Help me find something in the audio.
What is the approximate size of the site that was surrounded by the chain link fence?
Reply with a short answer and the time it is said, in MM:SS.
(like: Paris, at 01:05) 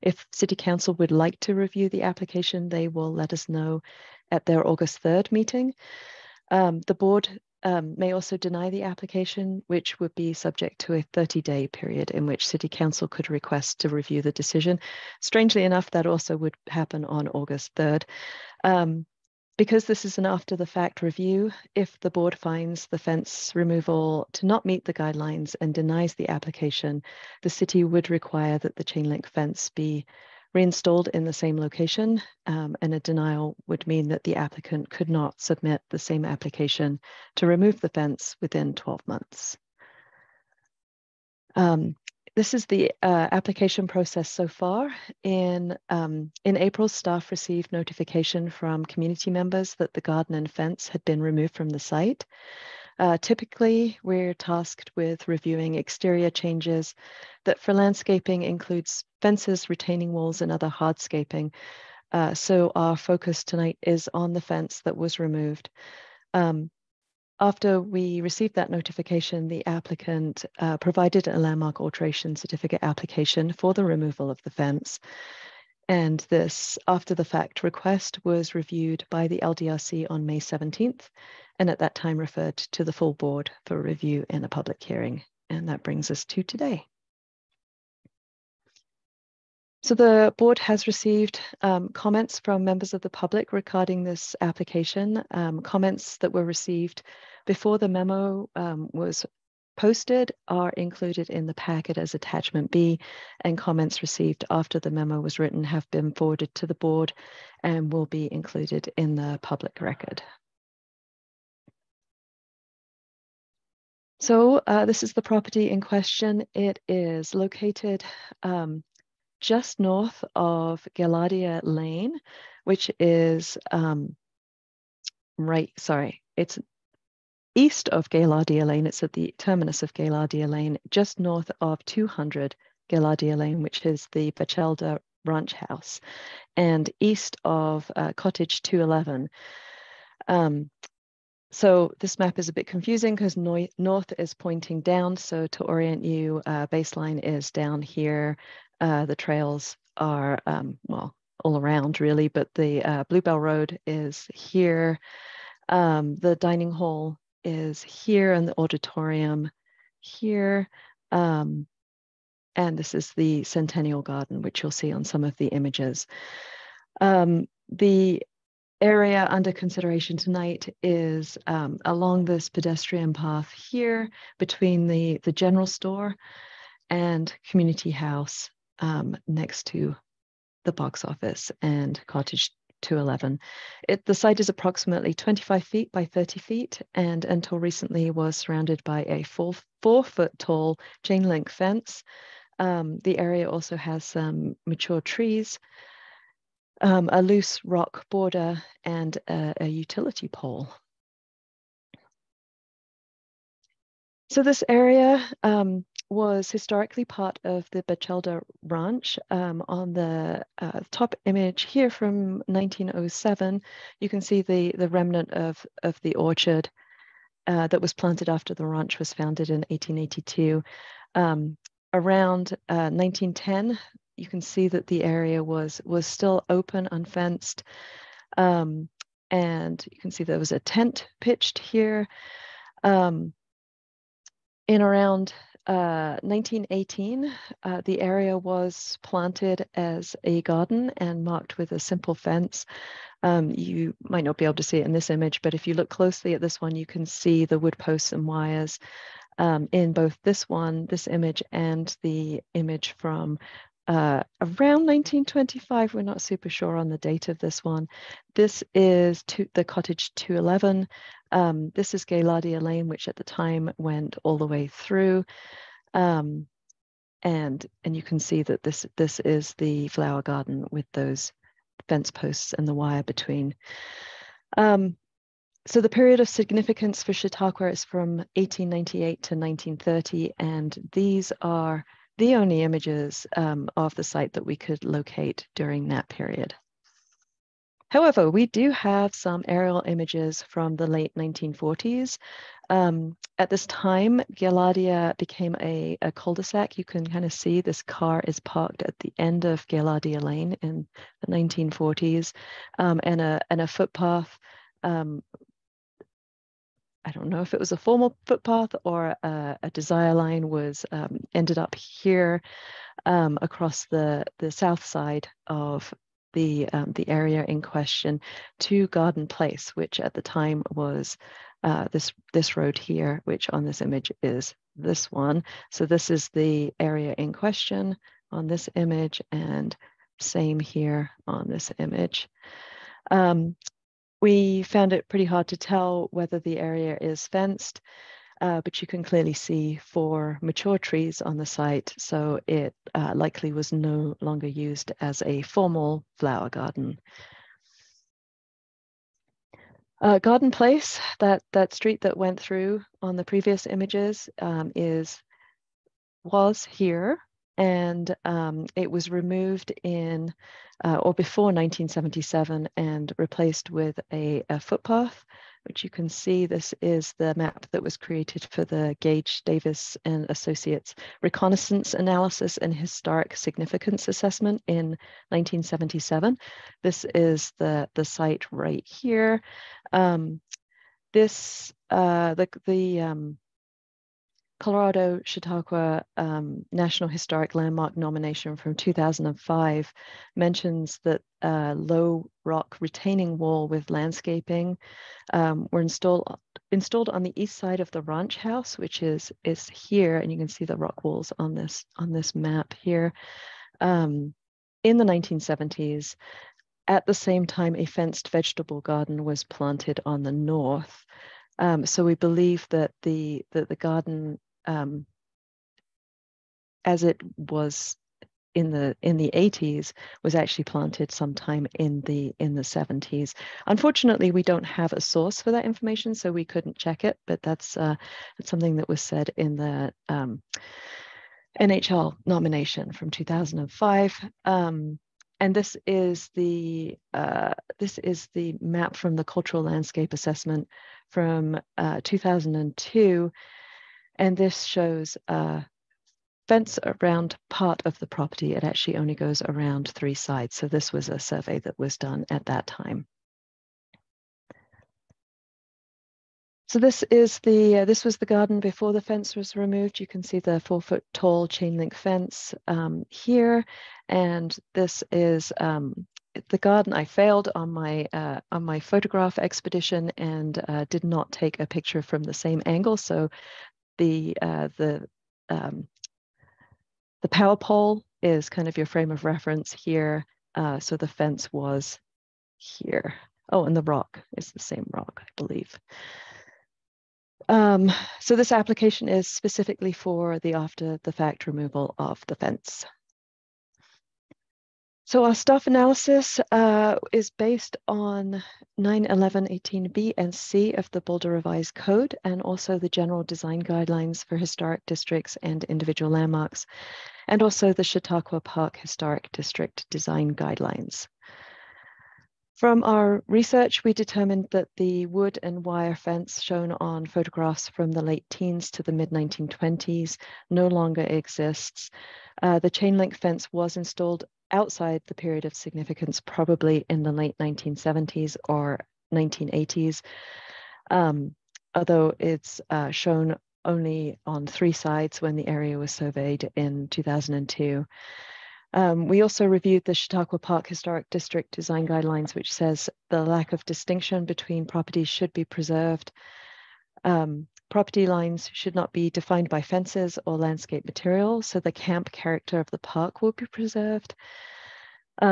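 25 feet by 30 feet, at 03:05.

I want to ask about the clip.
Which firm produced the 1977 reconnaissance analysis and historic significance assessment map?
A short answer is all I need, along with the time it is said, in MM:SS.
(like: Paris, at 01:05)
Gage Davis and Associates, at 06:09.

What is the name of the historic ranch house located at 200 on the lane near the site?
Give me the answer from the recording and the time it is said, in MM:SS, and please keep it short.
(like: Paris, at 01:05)
Bachelda Ranch House, at 02:14.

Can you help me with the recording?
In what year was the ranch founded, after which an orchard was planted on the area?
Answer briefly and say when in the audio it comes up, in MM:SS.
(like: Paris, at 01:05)
1882, at 03:39.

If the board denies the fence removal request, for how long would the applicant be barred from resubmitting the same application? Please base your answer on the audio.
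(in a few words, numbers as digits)
12 months.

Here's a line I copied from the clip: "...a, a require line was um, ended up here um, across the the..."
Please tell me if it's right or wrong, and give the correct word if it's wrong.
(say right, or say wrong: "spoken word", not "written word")
wrong: "desire", not "require".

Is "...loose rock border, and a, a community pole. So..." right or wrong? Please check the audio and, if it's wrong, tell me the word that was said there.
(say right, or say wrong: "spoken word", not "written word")
wrong: "utility", not "community".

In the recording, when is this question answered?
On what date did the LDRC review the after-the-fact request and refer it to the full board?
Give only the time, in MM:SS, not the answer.
01:20.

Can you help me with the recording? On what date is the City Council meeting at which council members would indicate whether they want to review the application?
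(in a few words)
August 3rd.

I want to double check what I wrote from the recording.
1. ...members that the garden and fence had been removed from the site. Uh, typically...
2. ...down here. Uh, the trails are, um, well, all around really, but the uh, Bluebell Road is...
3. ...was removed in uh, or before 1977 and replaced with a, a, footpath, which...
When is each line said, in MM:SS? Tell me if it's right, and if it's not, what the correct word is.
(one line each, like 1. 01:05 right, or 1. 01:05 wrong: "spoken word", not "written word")
1. 00:49 right
2. 02:27 right
3. 05:58 right.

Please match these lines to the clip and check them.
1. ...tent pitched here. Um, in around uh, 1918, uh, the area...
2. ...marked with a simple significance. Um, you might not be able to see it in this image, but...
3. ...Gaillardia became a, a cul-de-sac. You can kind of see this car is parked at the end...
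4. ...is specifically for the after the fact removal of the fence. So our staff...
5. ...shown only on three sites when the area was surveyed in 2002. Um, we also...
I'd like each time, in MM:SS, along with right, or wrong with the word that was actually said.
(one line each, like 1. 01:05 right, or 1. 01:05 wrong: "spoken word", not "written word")
1. 03:50 right
2. 04:01 wrong: "fence", not "significance"
3. 04:54 right
4. 08:09 right
5. 08:52 right.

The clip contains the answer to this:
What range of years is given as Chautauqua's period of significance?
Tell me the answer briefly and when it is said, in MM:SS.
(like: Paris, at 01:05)
1898 to 1930, at 04:38.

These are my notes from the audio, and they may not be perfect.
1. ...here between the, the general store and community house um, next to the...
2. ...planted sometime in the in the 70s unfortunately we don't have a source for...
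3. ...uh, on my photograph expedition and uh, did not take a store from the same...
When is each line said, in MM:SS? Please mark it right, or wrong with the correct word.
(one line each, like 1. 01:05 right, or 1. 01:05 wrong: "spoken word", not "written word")
1. 02:53 right
2. 07:00 right
3. 07:48 wrong: "picture", not "store".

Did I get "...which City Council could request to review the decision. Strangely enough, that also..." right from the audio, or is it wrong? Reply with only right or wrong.
right.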